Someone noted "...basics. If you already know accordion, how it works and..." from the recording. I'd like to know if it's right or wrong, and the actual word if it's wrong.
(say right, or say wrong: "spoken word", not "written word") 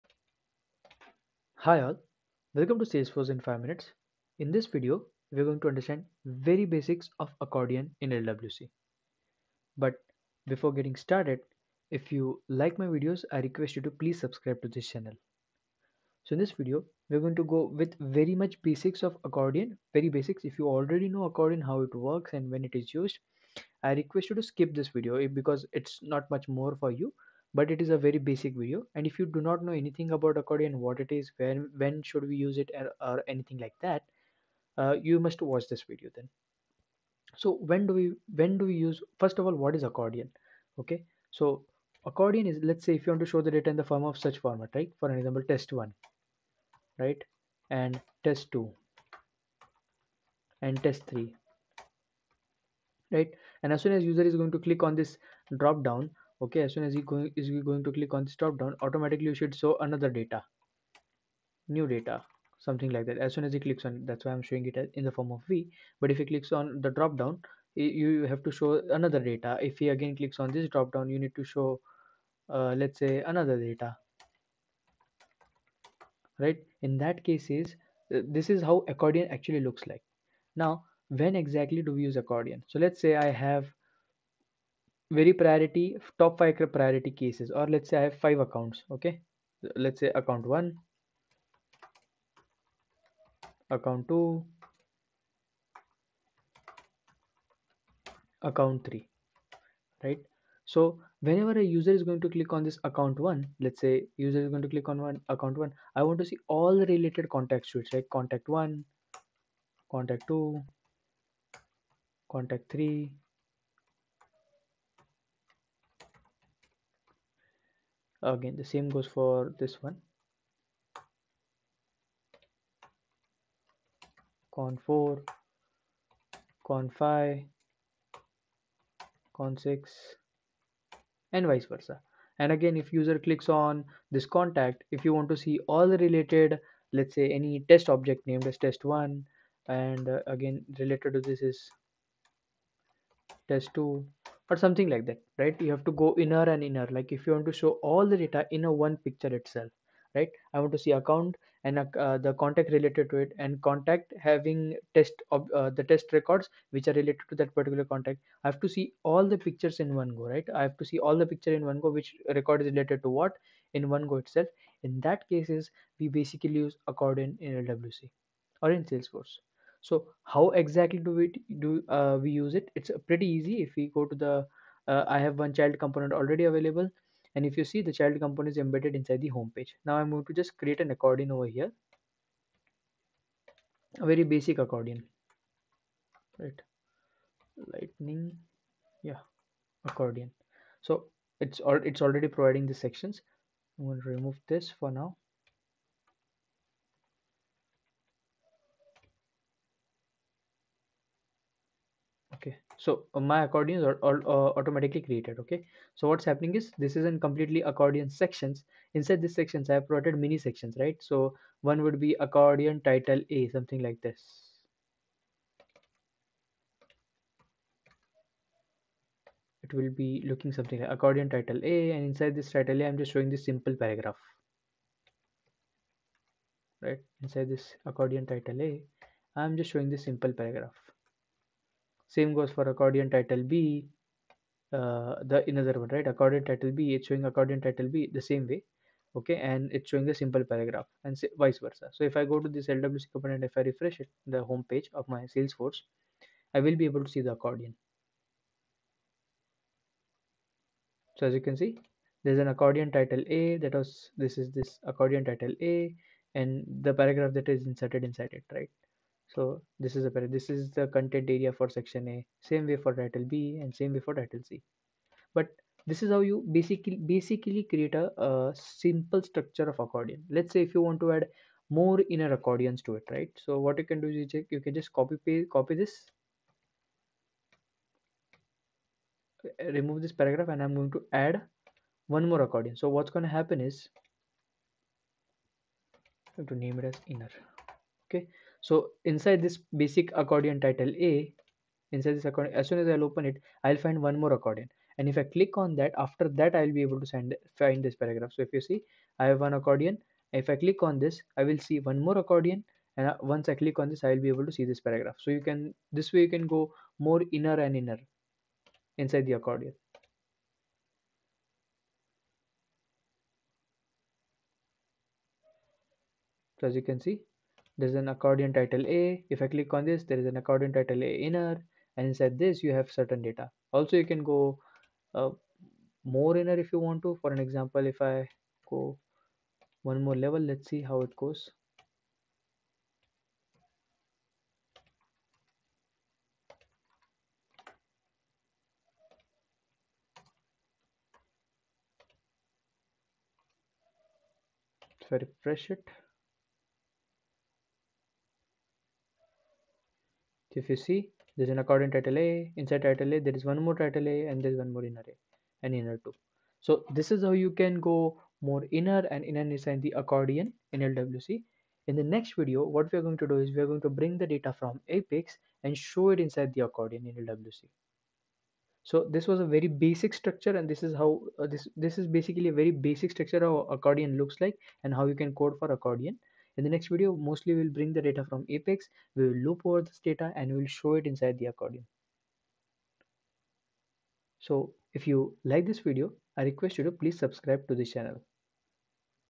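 right.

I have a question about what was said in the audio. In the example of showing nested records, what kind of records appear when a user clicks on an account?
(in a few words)
contacts.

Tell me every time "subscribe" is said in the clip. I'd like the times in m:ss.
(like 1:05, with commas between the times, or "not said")
0:14, 6:27.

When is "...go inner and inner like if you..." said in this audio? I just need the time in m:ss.
2:25.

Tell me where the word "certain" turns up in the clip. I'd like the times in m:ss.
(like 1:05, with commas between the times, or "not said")
5:22.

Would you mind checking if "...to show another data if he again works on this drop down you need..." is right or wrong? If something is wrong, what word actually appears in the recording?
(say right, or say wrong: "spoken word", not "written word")
wrong: "clicks", not "works".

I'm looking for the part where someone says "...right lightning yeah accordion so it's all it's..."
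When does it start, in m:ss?
3:06.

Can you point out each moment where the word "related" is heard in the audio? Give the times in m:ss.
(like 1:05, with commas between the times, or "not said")
1:46, 2:15, 2:20, 2:32, 2:36, 2:42.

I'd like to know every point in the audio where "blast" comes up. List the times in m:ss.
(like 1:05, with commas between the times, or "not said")
not said.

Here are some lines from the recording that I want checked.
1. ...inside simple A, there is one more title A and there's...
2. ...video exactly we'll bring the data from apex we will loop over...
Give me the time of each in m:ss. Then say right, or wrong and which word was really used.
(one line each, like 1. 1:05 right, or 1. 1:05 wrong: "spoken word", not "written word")
1. 5:52 wrong: "title", not "simple"
2. 6:16 wrong: "mostly", not "exactly".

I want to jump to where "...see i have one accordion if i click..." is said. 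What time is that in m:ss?
4:58.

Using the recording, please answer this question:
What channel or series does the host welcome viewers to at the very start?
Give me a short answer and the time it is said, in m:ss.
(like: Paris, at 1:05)
Salesforce in 5 minutes, at 0:02.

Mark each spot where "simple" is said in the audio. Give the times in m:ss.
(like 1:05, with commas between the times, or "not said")
3:43, 3:50, 4:00, 4:28.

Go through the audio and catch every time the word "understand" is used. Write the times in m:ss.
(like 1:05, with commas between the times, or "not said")
0:05.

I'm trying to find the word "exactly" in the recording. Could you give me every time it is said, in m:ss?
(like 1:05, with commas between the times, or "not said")
1:21, 2:50.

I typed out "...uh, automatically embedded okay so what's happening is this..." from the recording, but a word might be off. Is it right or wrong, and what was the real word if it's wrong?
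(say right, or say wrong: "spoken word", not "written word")
wrong: "created", not "embedded".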